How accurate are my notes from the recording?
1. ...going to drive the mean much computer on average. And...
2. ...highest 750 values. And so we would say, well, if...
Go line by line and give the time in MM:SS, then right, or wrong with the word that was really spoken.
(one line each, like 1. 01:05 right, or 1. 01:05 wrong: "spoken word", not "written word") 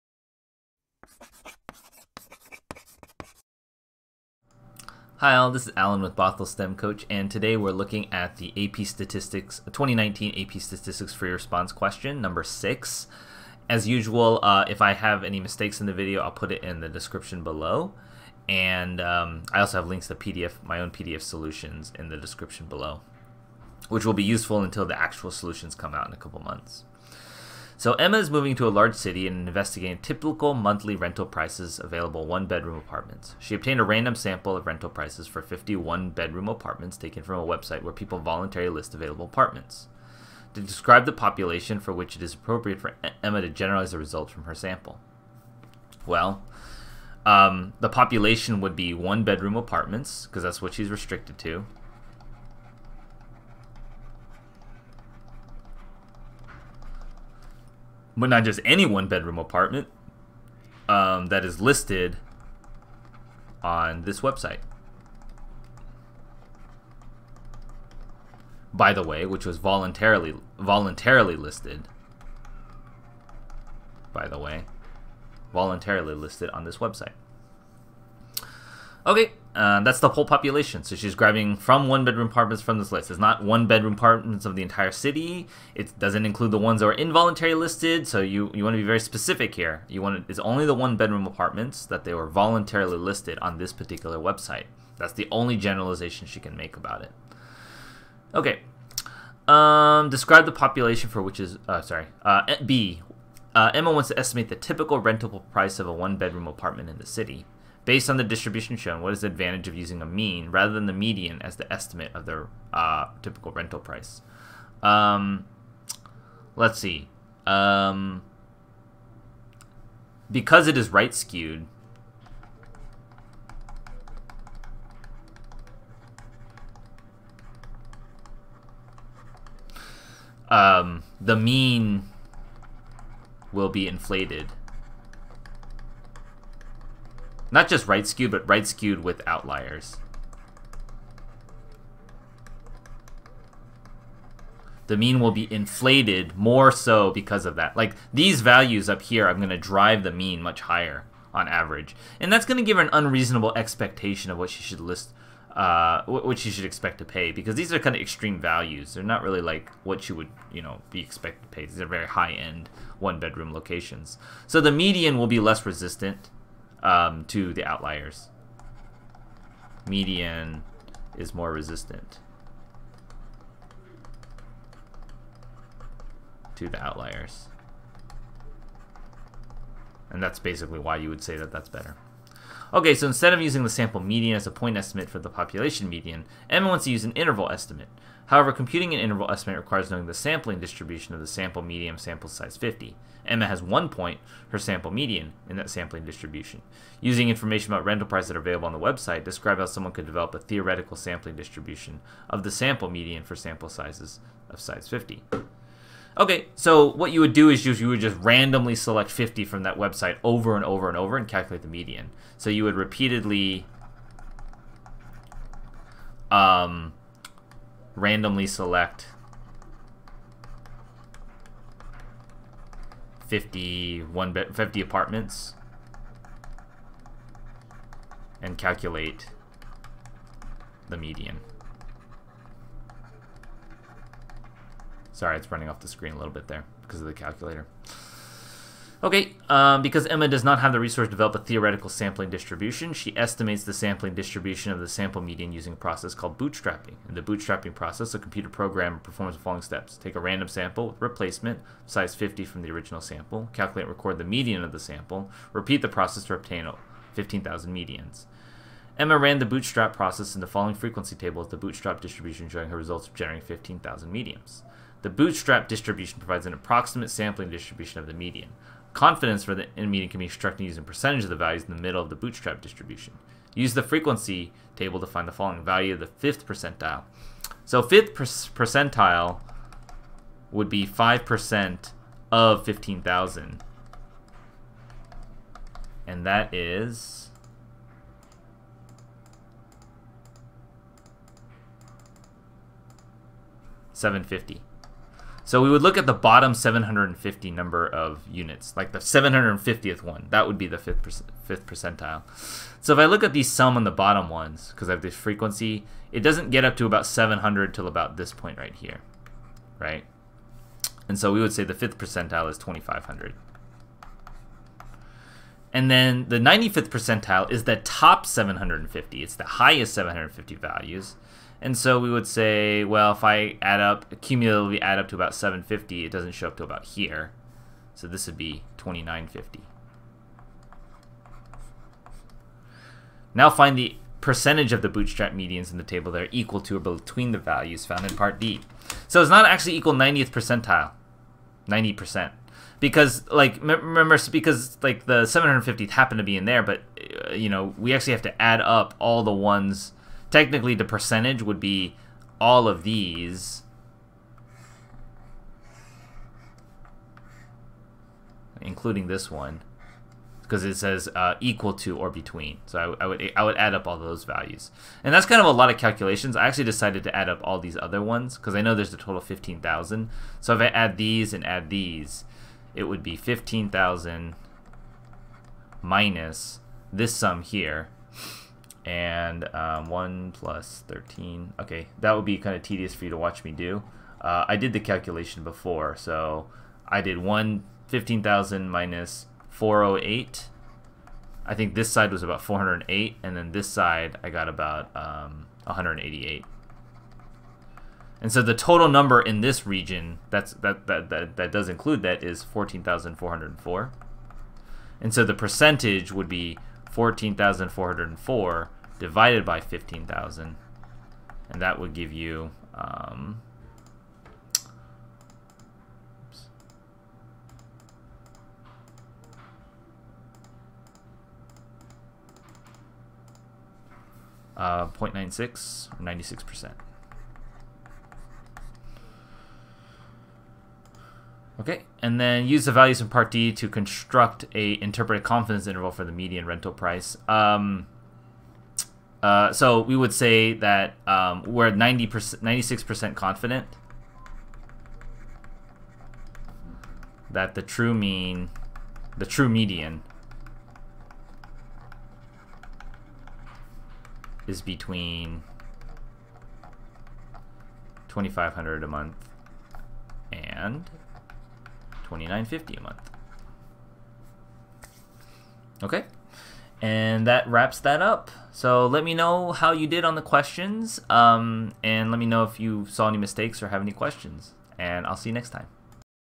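1. 02:29 wrong: "higher", not "computer"
2. 05:19 right.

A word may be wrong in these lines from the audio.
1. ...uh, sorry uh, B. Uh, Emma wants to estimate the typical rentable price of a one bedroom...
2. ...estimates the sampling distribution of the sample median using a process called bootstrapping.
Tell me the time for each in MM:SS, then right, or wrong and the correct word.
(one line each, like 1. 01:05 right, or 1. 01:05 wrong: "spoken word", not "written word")
1. 01:41 right
2. 04:03 right.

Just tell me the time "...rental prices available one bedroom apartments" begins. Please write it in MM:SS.
00:30.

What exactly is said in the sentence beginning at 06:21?
Okay, that would be kind of tedious for you to watch me do.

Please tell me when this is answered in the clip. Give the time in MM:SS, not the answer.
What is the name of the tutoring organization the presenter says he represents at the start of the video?
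00:06.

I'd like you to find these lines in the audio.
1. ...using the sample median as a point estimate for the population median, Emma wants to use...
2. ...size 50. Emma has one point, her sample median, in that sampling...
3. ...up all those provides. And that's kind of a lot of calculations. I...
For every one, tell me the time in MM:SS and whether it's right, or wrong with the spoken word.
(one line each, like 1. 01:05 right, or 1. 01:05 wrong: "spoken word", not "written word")
1. 03:03 right
2. 03:12 right
3. 06:03 wrong: "values", not "provides".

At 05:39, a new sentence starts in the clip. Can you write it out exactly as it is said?
So it's not actually equal 90th percentile, 90%.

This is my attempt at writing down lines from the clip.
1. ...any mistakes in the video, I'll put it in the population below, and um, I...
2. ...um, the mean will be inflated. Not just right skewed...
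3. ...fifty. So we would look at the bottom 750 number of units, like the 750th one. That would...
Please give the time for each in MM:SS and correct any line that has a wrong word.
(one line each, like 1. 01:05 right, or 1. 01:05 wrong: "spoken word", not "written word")
1. 00:15 wrong: "description", not "population"
2. 02:10 right
3. 04:54 right.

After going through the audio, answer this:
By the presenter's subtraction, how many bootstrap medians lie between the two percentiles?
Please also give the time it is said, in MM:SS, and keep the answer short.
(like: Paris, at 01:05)
14,404, at 06:42.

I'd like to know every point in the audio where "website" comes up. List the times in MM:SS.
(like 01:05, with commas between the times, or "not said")
00:37, 01:04, 01:16, 01:34, 03:18, 03:29.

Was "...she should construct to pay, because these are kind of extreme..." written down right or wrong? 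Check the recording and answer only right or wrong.
wrong.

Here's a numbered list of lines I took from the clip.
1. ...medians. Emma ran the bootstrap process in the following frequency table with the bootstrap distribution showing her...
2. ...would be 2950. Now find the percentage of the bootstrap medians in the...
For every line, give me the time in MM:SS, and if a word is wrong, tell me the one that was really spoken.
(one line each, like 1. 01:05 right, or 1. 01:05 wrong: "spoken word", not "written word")
1. 04:17 right
2. 05:28 right.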